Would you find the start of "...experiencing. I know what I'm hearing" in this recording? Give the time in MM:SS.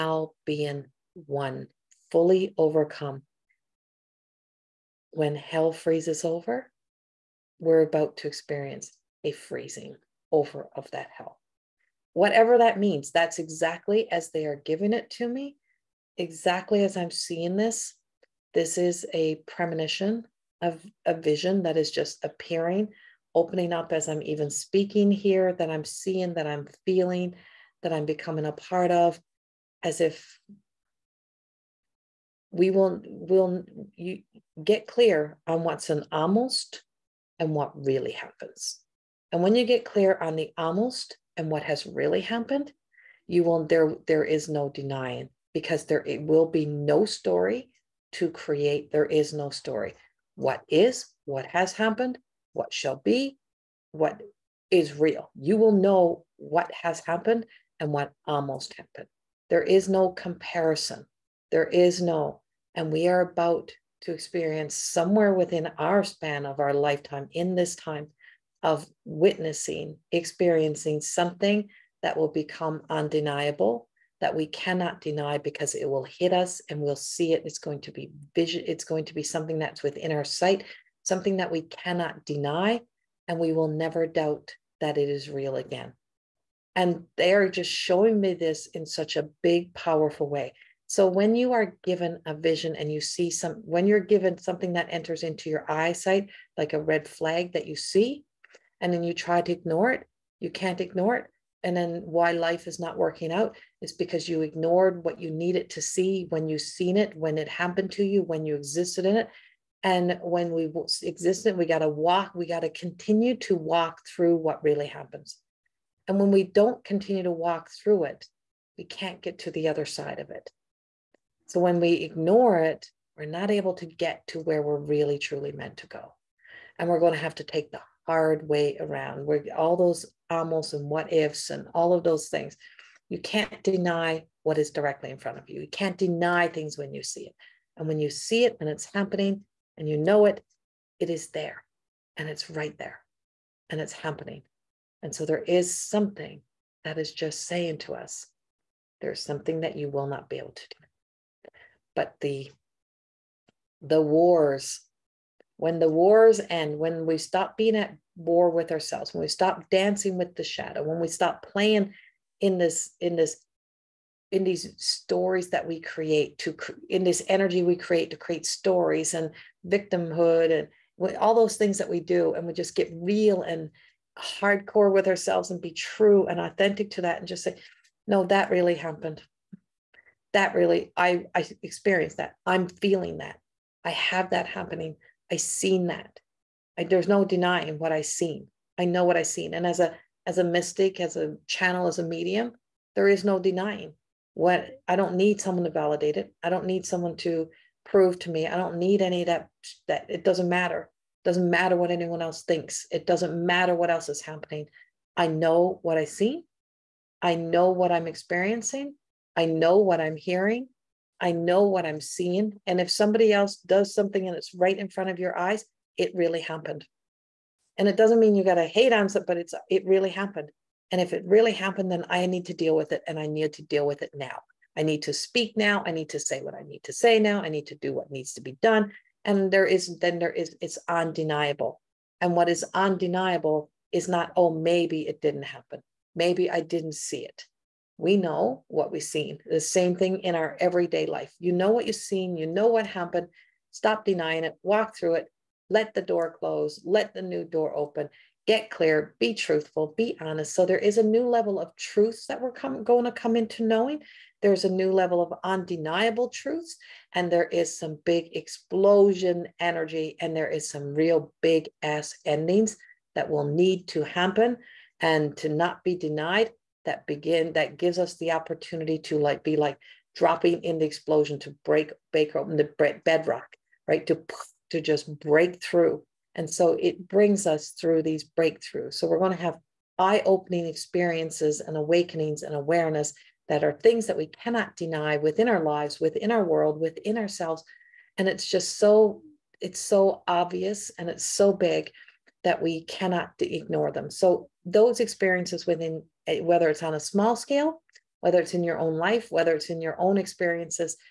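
03:28.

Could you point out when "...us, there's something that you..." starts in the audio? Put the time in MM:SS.
02:27.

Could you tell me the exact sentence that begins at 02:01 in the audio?
So when we ignore it, we're not able to get to where we're really truly meant to go.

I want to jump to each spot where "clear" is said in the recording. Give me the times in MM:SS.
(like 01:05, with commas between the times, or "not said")
00:34, 00:39, 04:08.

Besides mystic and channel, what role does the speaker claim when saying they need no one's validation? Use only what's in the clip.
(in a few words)
medium.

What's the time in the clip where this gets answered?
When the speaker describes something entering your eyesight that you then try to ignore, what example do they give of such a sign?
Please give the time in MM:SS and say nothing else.
01:36.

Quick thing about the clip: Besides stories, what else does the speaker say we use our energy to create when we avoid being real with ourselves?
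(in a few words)
victimhood.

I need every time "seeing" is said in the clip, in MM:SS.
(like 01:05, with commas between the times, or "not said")
00:17, 00:25, 03:31.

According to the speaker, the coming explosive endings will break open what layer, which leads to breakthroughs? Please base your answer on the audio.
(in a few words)
bedrock.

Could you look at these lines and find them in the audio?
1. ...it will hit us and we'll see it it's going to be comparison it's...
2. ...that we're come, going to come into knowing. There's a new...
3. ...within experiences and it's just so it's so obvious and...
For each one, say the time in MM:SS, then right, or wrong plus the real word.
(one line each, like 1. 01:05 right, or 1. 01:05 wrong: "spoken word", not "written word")
1. 01:15 wrong: "vision", not "comparison"
2. 04:12 right
3. 04:46 wrong: "ourselves", not "experiences".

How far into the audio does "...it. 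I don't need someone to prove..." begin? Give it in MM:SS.
03:16.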